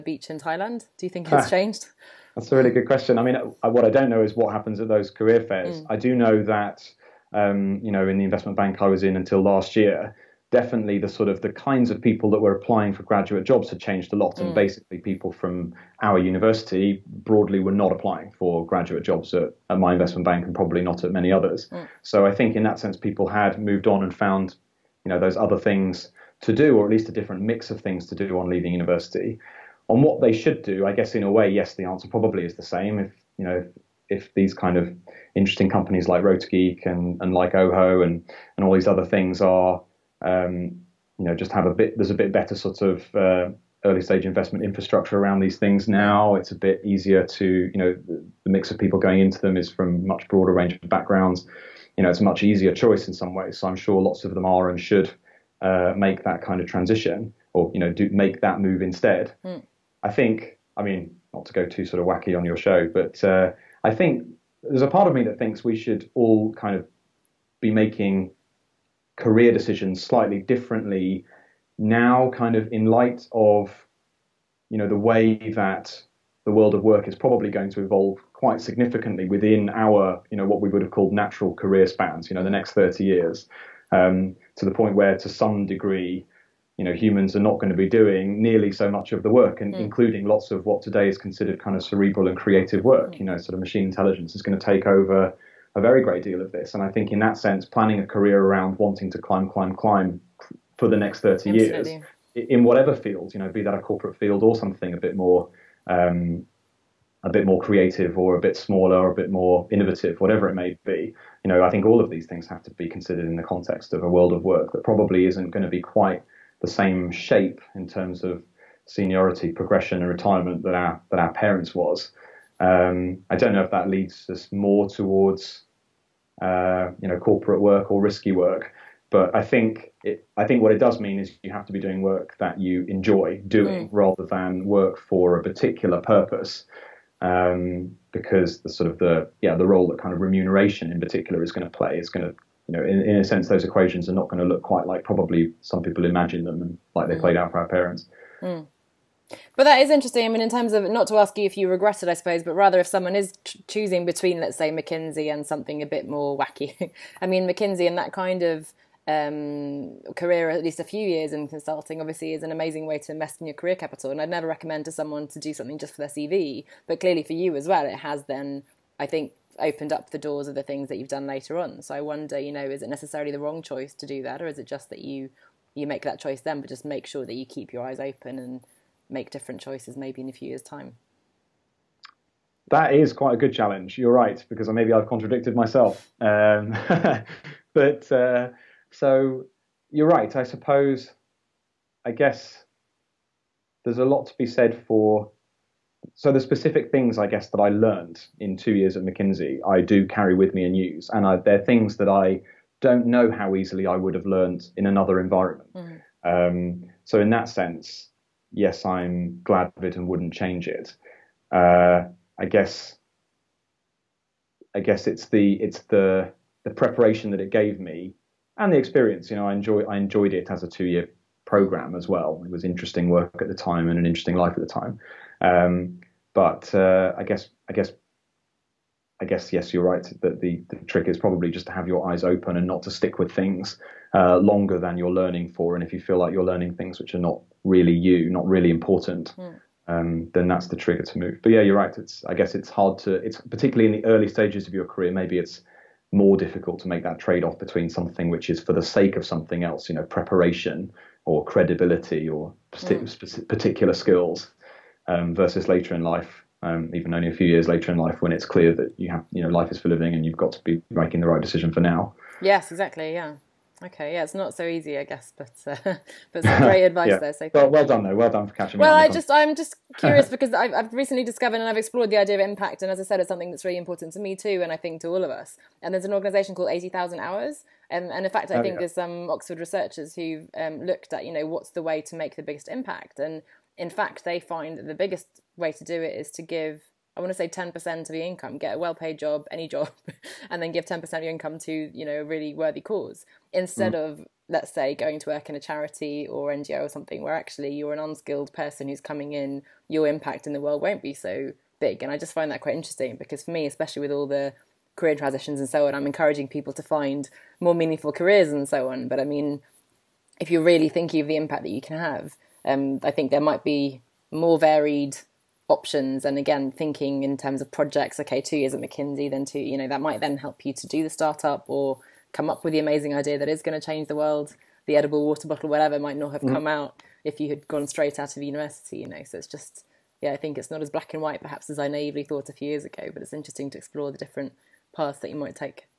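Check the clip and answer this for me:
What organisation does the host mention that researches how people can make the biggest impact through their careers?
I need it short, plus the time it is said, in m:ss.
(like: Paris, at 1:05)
Eighty Thousand Hours, at 4:36.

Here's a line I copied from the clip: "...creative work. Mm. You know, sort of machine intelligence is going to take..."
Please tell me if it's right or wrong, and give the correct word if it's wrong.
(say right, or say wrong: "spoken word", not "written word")
right.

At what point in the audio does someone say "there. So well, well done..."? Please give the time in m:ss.
4:27.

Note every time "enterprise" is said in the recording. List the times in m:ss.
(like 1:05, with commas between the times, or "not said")
not said.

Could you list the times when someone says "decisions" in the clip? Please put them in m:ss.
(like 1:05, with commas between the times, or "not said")
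1:09, 4:21.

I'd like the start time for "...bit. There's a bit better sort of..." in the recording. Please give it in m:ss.
0:41.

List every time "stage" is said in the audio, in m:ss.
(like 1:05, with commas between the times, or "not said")
0:44, 4:04.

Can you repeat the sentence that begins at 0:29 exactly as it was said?
On what they should do, I guess in a way, yes, the answer probably is the same.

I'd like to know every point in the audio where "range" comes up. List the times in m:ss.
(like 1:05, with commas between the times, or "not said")
0:50.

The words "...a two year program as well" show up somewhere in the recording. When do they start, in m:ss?
3:40.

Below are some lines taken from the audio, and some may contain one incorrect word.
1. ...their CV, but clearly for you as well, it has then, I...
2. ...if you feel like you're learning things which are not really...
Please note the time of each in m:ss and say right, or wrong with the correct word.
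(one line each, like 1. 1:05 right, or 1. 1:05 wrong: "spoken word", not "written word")
1. 2:46 right
2. 3:55 right.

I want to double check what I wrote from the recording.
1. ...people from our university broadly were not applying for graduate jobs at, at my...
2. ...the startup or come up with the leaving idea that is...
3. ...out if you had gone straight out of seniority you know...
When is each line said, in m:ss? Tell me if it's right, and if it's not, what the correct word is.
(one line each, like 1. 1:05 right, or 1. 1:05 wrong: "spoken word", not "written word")
1. 0:14 right
2. 5:21 wrong: "amazing", not "leaving"
3. 5:26 wrong: "university", not "seniority".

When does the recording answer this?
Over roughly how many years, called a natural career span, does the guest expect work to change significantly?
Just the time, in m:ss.
1:22.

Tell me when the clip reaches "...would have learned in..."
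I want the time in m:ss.
3:23.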